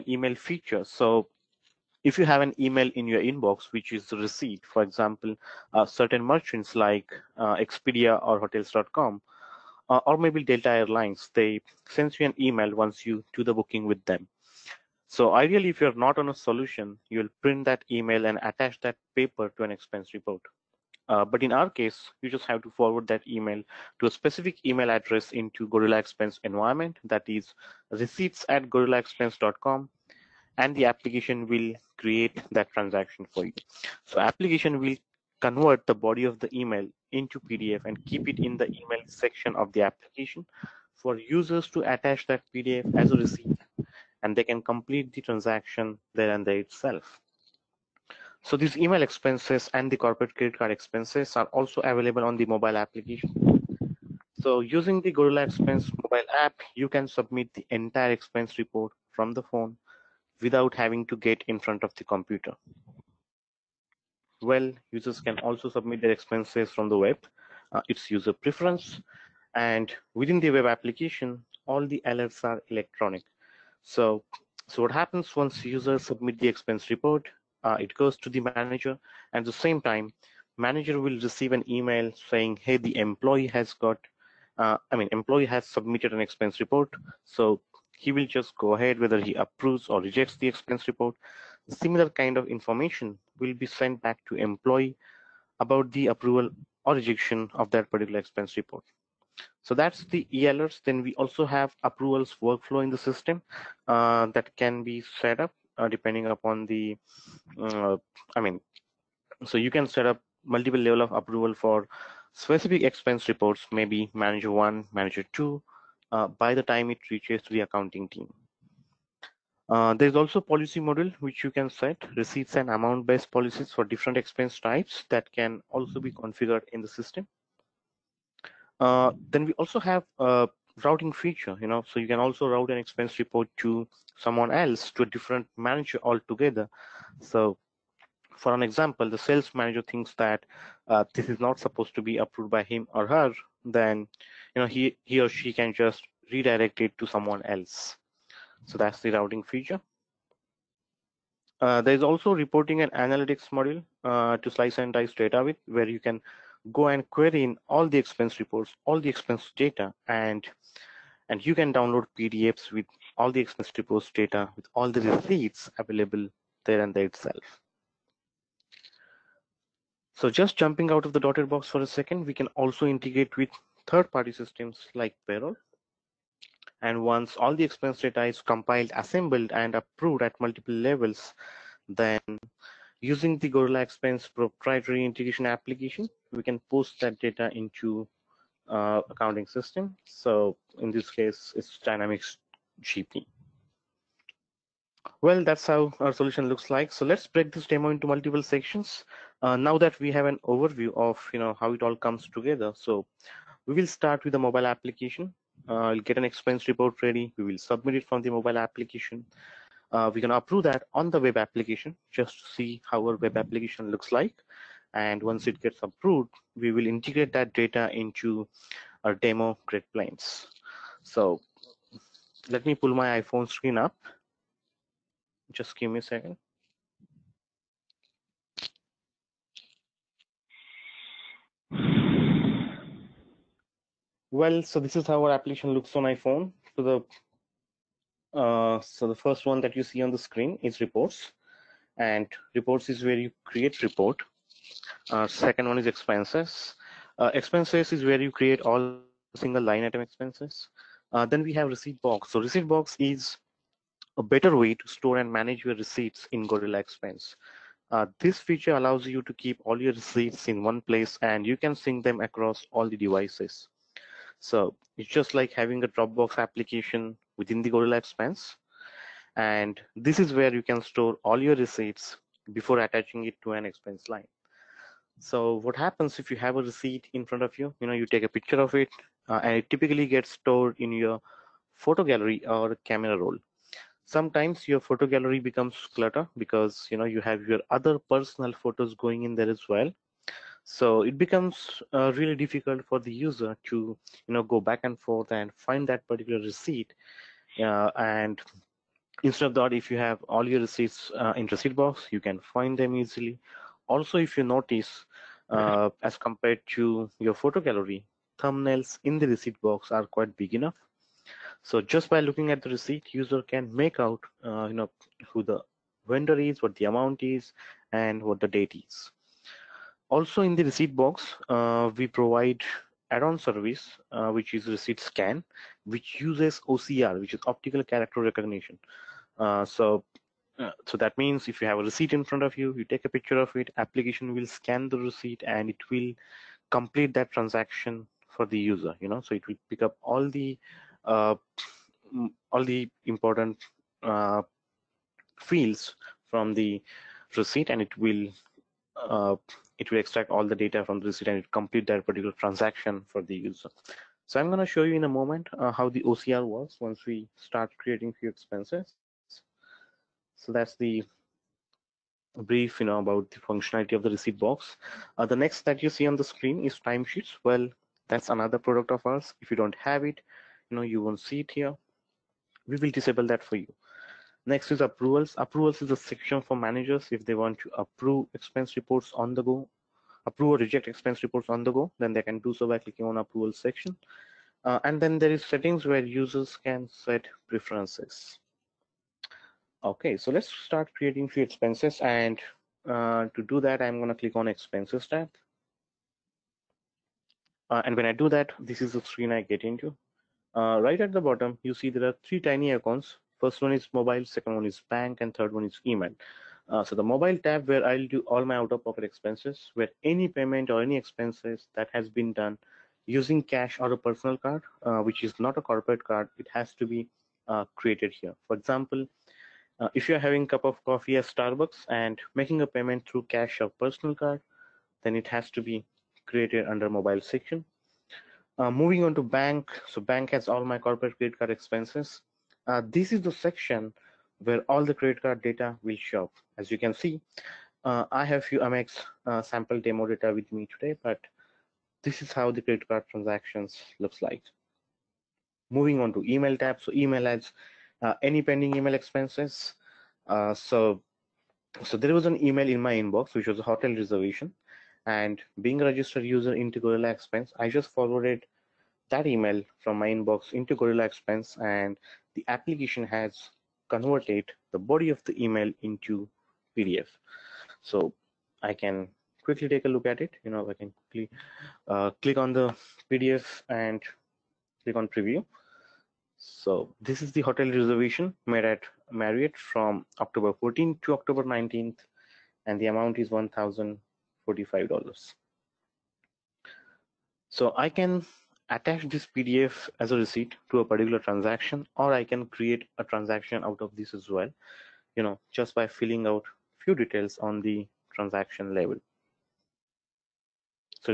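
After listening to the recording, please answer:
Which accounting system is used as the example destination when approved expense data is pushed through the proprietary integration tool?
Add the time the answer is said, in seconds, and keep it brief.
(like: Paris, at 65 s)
Dynamics GP, at 191 s.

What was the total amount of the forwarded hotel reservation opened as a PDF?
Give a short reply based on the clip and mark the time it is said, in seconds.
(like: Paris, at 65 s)
$1,045, at 483 s.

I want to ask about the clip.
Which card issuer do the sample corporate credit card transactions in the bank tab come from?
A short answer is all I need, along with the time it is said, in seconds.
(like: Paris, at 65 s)
Amex, at 438 s.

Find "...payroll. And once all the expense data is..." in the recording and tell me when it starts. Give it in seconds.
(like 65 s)
175 s.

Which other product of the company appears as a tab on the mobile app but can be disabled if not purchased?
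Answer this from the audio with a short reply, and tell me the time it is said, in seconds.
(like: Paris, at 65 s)
timesheets, at 366 s.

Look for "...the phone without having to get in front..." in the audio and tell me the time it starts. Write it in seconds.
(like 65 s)
59 s.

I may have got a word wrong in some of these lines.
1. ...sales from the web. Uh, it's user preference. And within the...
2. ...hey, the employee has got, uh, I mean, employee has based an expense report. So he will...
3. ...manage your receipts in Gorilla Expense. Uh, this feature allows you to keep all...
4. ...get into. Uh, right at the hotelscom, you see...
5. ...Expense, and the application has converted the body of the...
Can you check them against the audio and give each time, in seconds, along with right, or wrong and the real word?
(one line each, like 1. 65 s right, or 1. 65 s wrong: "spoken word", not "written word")
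1. 66 s wrong: "expenses", not "sales"
2. 82 s wrong: "submitted", not "based"
3. 255 s right
4. 399 s wrong: "bottom", not "hotelscom"
5. 461 s right.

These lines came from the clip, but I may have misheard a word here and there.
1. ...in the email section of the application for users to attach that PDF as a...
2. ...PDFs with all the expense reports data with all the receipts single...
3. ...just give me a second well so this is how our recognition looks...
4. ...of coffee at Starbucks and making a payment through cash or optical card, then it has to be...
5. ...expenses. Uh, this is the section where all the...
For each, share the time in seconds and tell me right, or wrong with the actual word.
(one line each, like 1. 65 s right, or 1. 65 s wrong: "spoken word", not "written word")
1. 38 s right
2. 162 s wrong: "available", not "single"
3. 225 s wrong: "application", not "recognition"
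4. 420 s wrong: "personal", not "optical"
5. 431 s right.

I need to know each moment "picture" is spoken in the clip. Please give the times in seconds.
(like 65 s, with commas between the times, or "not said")
278 s, 333 s.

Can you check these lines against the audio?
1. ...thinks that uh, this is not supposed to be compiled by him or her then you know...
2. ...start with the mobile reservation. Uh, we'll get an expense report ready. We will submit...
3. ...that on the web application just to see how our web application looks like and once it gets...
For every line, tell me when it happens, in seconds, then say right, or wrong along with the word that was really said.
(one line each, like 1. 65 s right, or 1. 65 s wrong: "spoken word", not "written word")
1. 139 s wrong: "approved", not "compiled"
2. 203 s wrong: "application", not "reservation"
3. 210 s right.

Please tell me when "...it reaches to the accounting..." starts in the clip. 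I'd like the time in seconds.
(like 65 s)
116 s.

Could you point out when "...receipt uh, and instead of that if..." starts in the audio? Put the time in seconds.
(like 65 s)
296 s.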